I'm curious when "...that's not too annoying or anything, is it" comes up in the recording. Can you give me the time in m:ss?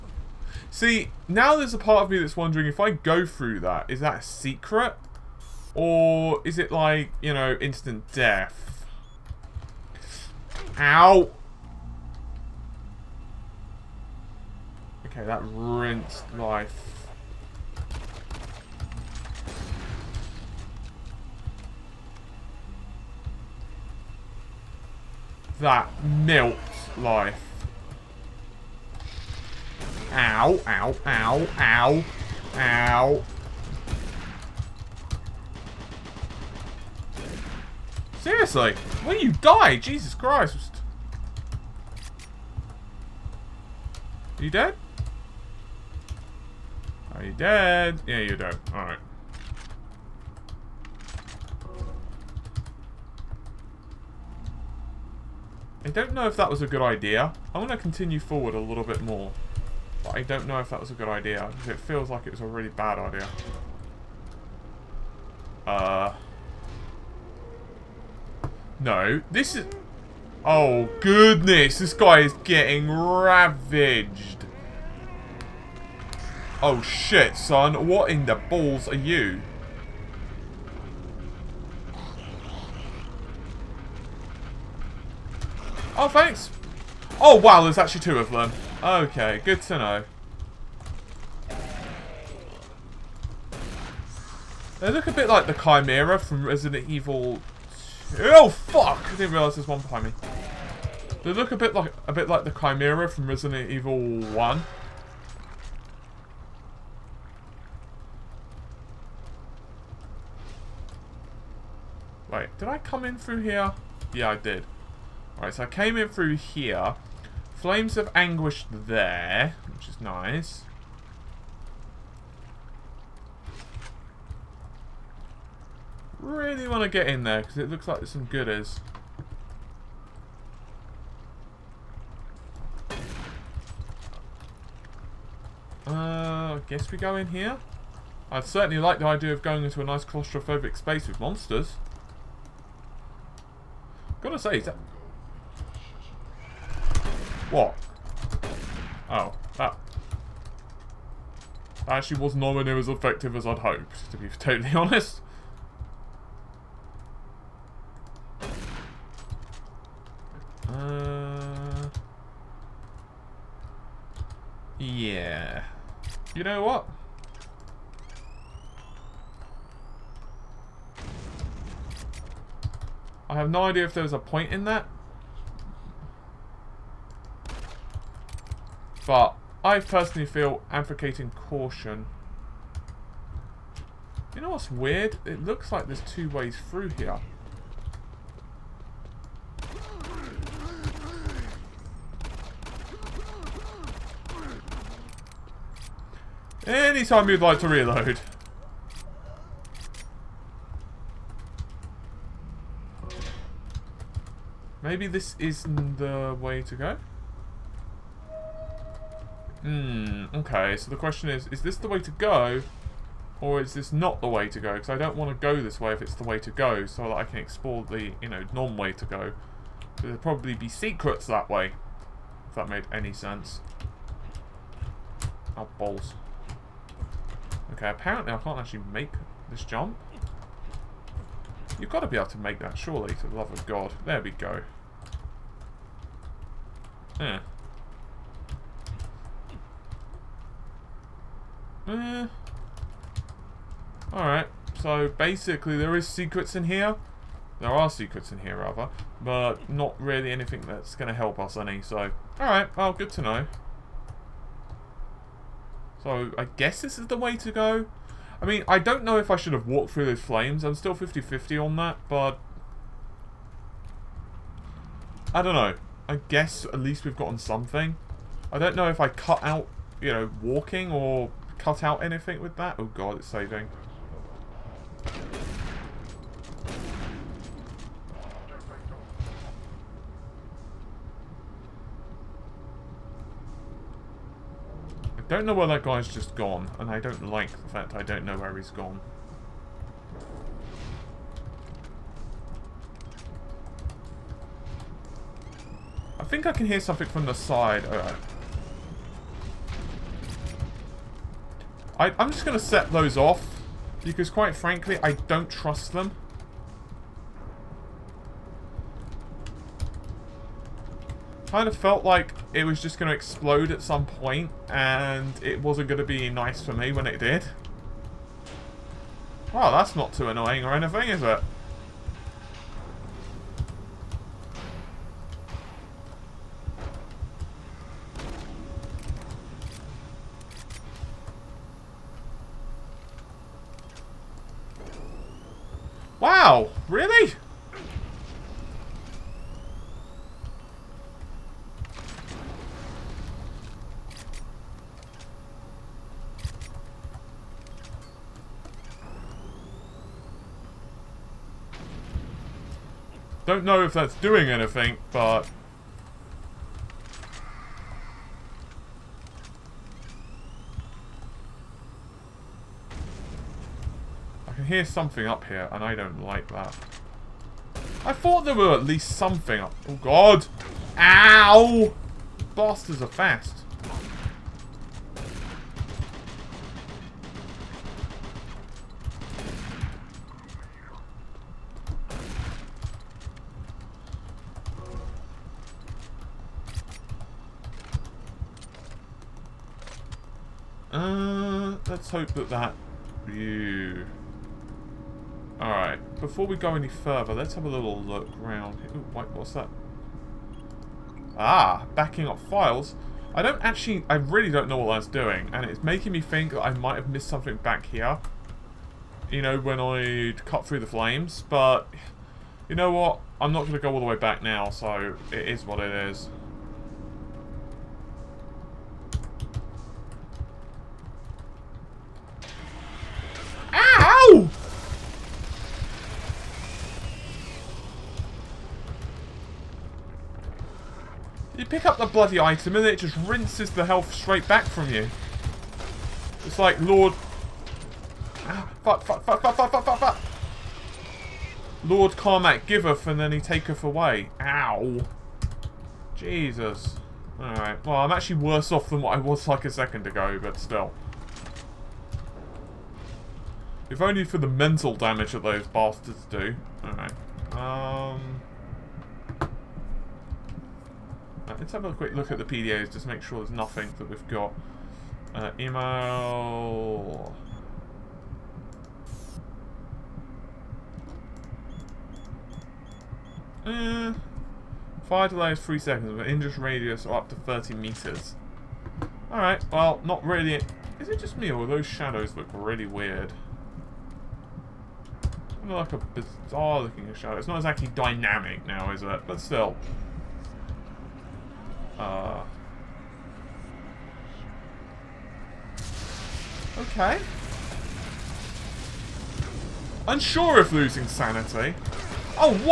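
5:19.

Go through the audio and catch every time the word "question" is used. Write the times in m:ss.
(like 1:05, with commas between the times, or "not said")
3:30.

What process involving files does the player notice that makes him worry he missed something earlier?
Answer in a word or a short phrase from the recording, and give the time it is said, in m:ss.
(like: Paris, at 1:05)
Backing up files, at 6:41.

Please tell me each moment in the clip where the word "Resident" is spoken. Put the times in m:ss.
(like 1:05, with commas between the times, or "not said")
1:36, 1:43.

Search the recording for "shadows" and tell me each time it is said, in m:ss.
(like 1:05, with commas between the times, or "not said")
8:01, 8:07.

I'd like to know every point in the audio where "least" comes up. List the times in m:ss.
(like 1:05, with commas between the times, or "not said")
4:26, 6:08.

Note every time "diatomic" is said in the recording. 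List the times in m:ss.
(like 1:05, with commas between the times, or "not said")
not said.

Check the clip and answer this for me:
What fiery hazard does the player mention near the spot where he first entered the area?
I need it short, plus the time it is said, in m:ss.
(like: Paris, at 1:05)
Flames of Anguish, at 1:57.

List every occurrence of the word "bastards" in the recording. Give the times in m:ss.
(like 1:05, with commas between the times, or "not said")
6:12, 7:35.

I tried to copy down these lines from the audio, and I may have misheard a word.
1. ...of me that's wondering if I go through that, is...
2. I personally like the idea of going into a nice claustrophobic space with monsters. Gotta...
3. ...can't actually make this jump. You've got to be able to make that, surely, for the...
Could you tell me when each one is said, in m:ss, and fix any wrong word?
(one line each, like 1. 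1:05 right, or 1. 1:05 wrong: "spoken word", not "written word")
1. 0:02 right
2. 2:18 wrong: "certainly", not "personally"
3. 3:48 right.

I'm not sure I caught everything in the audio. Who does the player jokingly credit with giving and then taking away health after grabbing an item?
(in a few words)
Lord Carmack.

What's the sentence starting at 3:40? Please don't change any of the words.
there'd probably be secrets that way.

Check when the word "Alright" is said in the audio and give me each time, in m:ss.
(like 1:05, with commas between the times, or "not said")
0:48, 1:55, 4:04, 4:12, 6:35, 7:27, 7:36, 7:59.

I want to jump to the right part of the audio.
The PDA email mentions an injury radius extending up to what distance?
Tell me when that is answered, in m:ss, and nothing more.
7:57.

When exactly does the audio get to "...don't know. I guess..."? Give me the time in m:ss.
4:25.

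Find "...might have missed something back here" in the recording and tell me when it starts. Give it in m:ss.
6:46.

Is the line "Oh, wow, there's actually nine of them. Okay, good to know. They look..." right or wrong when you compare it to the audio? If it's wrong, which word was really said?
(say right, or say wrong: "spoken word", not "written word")
wrong: "two", not "nine".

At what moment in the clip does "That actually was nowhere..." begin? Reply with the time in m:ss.
2:31.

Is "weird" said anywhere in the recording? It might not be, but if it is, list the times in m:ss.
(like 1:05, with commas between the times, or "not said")
3:04, 8:02.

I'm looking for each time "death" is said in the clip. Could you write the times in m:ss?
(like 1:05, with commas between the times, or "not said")
0:08.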